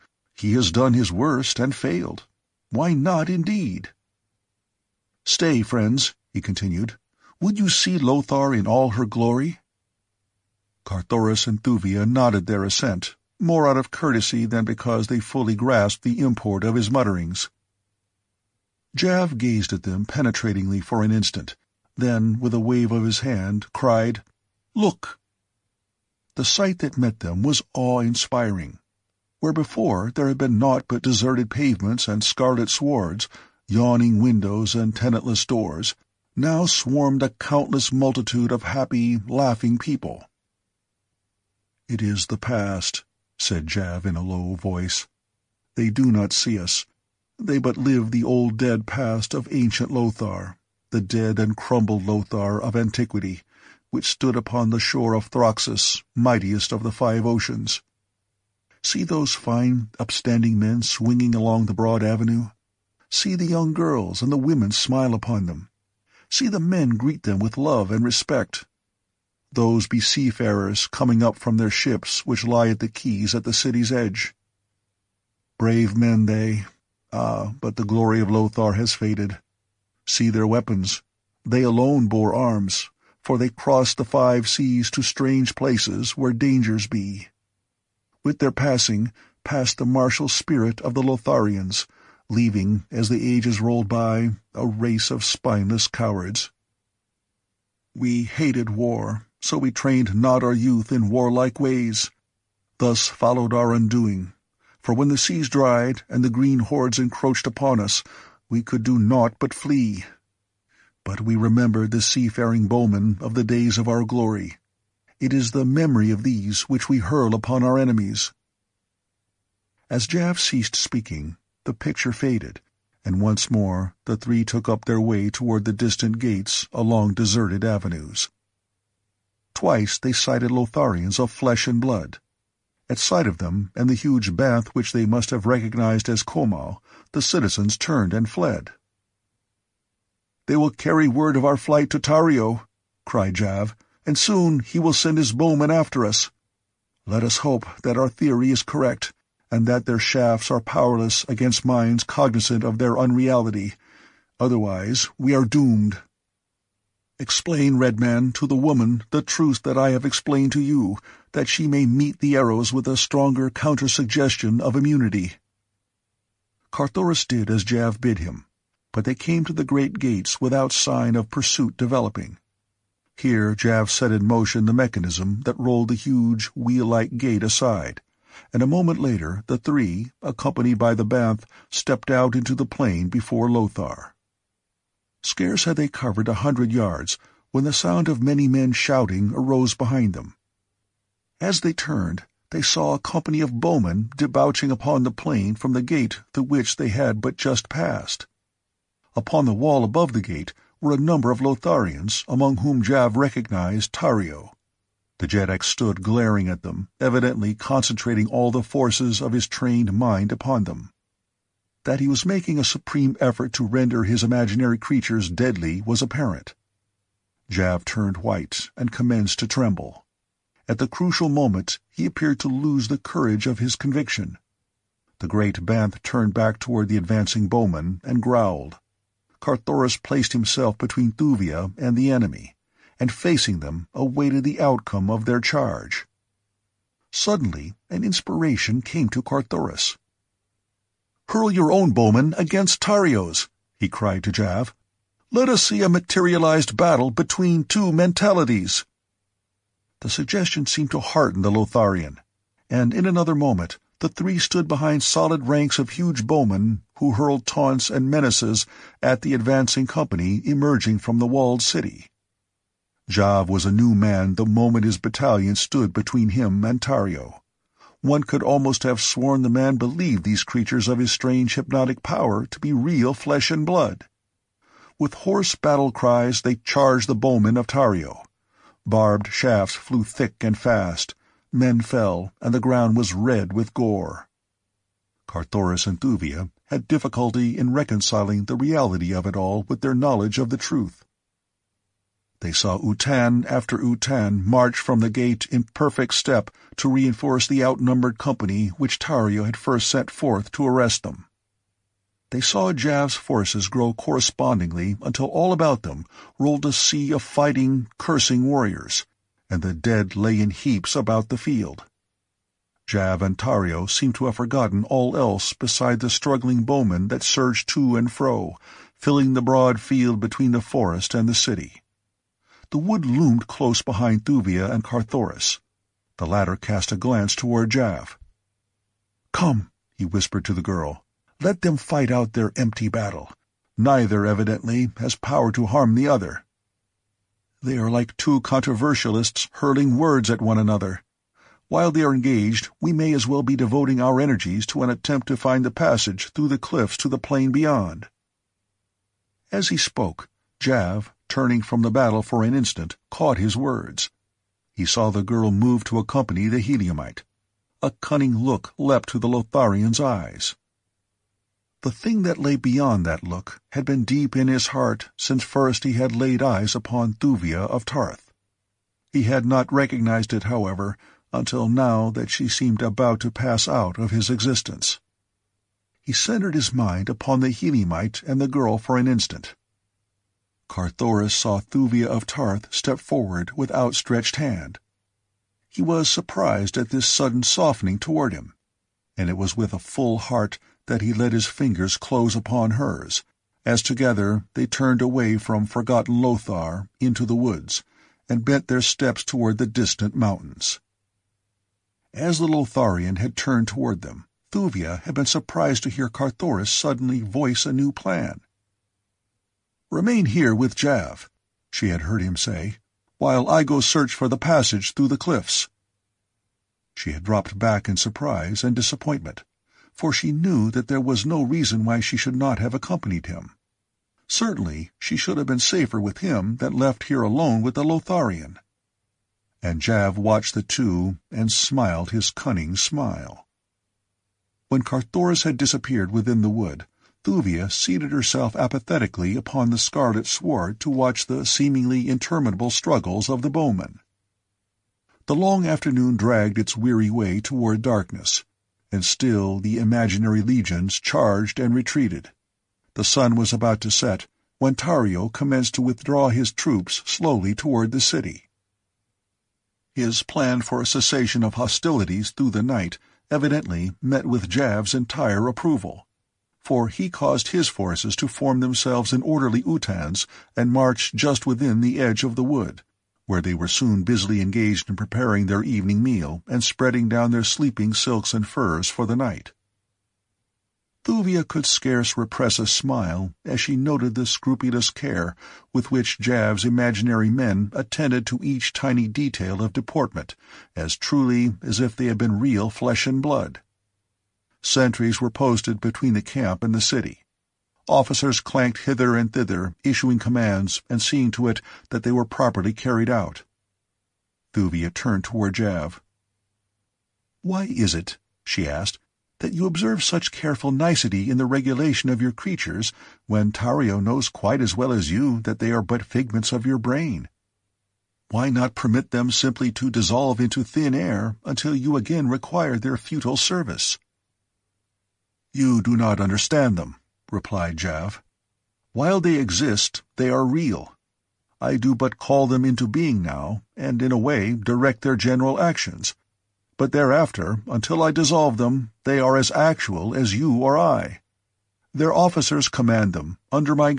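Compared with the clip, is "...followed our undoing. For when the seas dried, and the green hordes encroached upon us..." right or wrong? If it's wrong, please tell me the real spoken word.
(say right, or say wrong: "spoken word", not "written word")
right.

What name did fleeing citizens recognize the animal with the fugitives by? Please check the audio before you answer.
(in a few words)
Komal.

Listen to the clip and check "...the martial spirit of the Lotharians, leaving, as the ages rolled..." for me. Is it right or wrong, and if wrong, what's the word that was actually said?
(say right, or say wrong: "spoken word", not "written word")
right.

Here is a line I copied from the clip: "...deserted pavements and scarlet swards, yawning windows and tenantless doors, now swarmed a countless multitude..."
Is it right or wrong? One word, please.
right.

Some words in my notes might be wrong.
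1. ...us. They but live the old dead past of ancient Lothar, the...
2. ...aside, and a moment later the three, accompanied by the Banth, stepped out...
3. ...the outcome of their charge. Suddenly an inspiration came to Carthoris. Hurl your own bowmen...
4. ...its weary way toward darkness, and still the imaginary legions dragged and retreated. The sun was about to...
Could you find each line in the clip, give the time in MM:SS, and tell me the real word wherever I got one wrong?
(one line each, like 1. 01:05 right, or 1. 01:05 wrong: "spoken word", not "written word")
1. 00:46 right
2. 02:57 right
3. 03:54 right
4. 07:26 wrong: "charged", not "dragged".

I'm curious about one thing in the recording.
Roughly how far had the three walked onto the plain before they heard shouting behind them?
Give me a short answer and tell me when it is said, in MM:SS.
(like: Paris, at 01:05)
a hundred yards, at 03:06.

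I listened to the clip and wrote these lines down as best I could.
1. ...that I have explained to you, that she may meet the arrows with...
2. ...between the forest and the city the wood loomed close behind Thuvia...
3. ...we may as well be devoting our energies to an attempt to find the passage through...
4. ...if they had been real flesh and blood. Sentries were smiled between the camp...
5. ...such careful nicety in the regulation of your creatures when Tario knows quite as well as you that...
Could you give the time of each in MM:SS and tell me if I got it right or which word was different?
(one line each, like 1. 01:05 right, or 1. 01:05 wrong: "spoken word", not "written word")
1. 02:39 right
2. 05:20 right
3. 05:42 right
4. 08:11 wrong: "posted", not "smiled"
5. 08:30 right.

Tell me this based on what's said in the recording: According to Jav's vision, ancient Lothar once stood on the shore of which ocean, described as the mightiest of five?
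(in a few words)
Throxus.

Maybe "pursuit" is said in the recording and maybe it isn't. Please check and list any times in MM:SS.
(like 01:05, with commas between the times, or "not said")
02:51.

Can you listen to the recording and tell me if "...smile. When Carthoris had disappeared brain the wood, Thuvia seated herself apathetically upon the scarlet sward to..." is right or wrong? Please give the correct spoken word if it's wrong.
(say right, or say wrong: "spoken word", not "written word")
wrong: "within", not "brain".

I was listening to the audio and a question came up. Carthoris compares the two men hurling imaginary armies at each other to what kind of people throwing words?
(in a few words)
controversialists.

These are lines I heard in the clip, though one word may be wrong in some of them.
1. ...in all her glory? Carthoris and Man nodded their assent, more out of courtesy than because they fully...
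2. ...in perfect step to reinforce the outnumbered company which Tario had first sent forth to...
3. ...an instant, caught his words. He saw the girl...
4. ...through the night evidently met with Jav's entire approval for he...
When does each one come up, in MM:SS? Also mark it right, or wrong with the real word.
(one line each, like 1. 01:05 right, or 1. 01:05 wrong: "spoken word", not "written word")
1. 00:08 wrong: "Thuvia", not "Man"
2. 04:55 right
3. 05:52 right
4. 07:42 right.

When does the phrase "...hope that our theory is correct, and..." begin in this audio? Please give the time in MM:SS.
02:27.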